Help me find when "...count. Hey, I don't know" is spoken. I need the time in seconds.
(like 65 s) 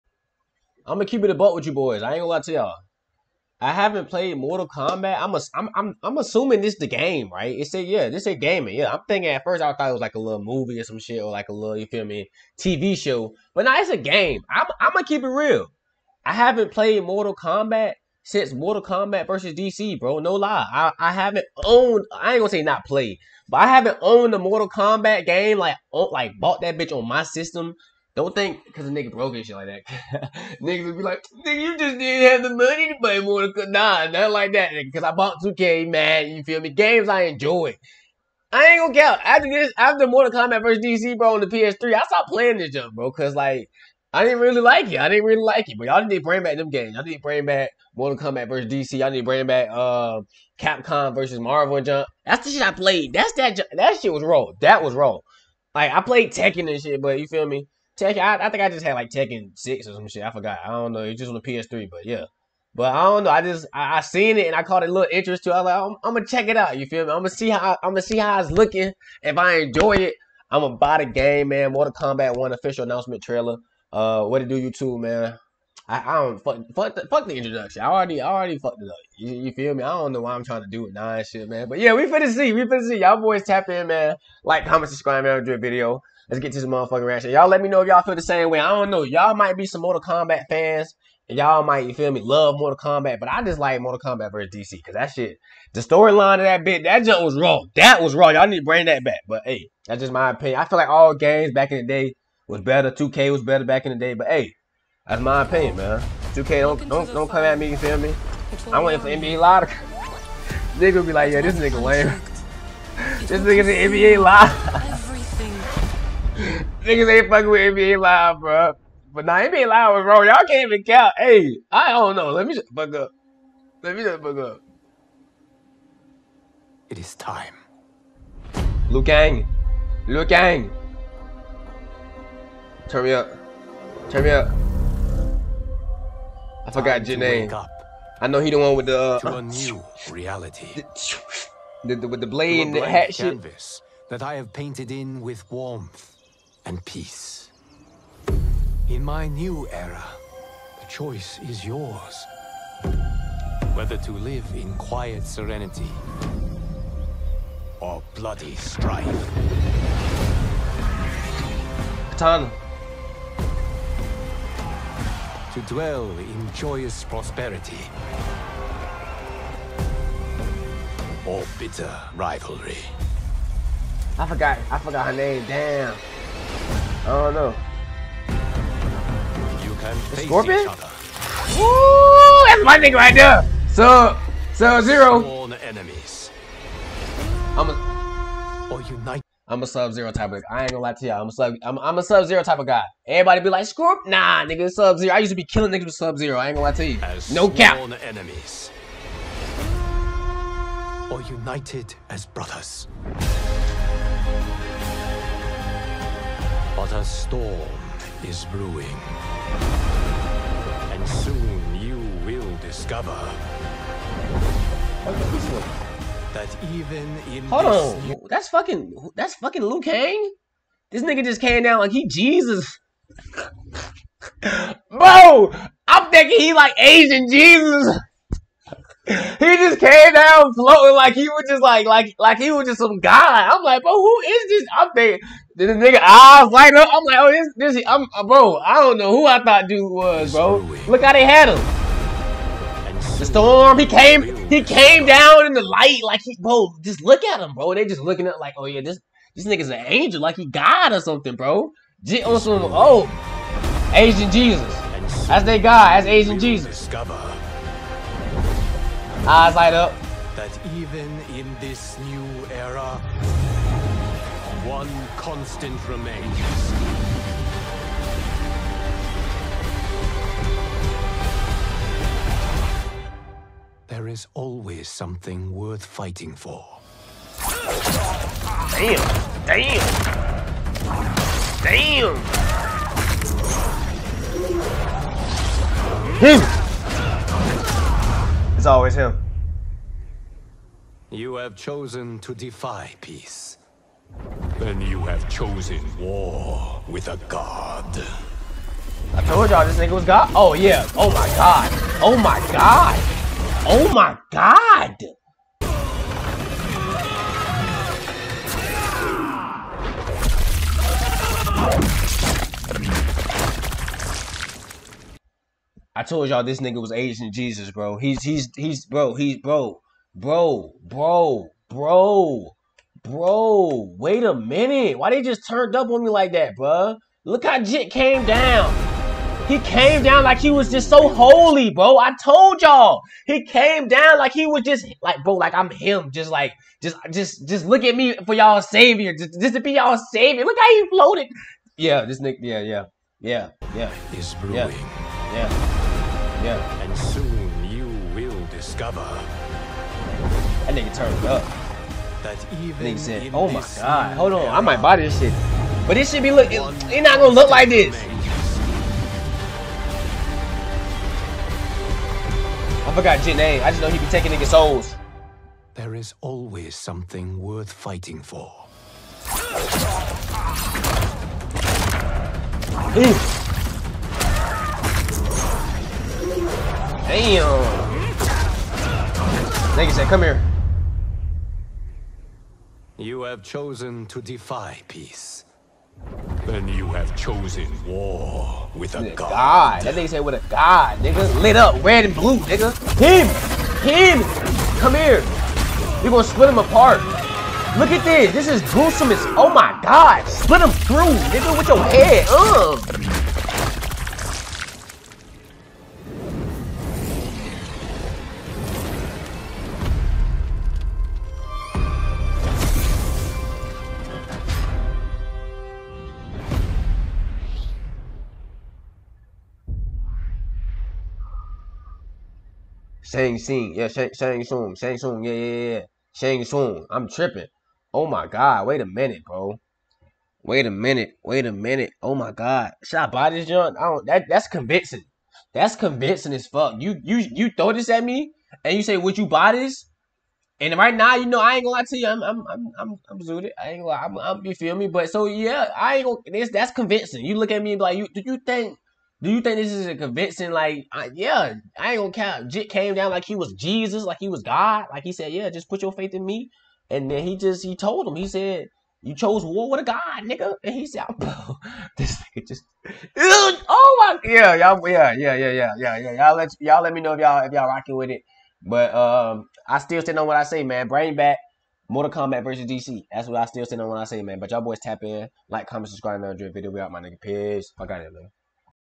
120 s.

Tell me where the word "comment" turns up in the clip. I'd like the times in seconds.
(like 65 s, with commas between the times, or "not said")
84 s, 475 s.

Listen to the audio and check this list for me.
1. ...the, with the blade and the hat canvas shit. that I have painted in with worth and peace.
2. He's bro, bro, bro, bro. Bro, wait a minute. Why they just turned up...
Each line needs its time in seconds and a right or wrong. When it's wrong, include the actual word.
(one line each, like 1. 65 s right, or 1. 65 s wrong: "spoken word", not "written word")
1. 141 s wrong: "warmth", not "worth"
2. 319 s right.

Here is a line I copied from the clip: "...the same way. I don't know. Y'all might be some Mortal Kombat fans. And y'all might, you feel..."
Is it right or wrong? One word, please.
right.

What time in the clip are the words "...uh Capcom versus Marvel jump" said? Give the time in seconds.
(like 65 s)
49 s.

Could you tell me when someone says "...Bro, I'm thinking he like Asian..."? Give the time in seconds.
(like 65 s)
224 s.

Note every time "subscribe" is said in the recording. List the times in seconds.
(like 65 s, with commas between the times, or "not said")
84 s, 475 s.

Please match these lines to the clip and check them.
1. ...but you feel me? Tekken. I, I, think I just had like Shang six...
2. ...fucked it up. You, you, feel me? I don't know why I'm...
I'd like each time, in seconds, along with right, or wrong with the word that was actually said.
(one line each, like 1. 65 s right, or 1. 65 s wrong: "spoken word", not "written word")
1. 57 s wrong: "Tekken", not "Shang"
2. 78 s right.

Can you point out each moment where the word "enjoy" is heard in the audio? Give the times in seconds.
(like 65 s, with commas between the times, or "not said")
37 s, 69 s, 476 s.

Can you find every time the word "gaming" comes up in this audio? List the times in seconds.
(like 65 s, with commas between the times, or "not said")
8 s.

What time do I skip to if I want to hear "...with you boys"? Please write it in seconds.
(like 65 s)
1 s.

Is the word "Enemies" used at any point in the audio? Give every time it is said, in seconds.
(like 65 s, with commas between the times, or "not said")
185 s, 198 s.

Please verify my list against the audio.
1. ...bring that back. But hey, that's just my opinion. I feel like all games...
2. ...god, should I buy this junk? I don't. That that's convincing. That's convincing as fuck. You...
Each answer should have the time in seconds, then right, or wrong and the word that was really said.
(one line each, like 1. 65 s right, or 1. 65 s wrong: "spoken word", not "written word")
1. 98 s right
2. 432 s right.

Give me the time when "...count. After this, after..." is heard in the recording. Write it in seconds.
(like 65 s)
38 s.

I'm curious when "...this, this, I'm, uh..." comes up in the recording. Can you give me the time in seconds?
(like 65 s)
237 s.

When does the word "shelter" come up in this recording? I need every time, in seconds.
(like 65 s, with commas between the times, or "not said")
not said.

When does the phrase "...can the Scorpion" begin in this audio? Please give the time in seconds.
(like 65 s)
179 s.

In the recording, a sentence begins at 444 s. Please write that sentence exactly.
But so yeah, I ain't gonna.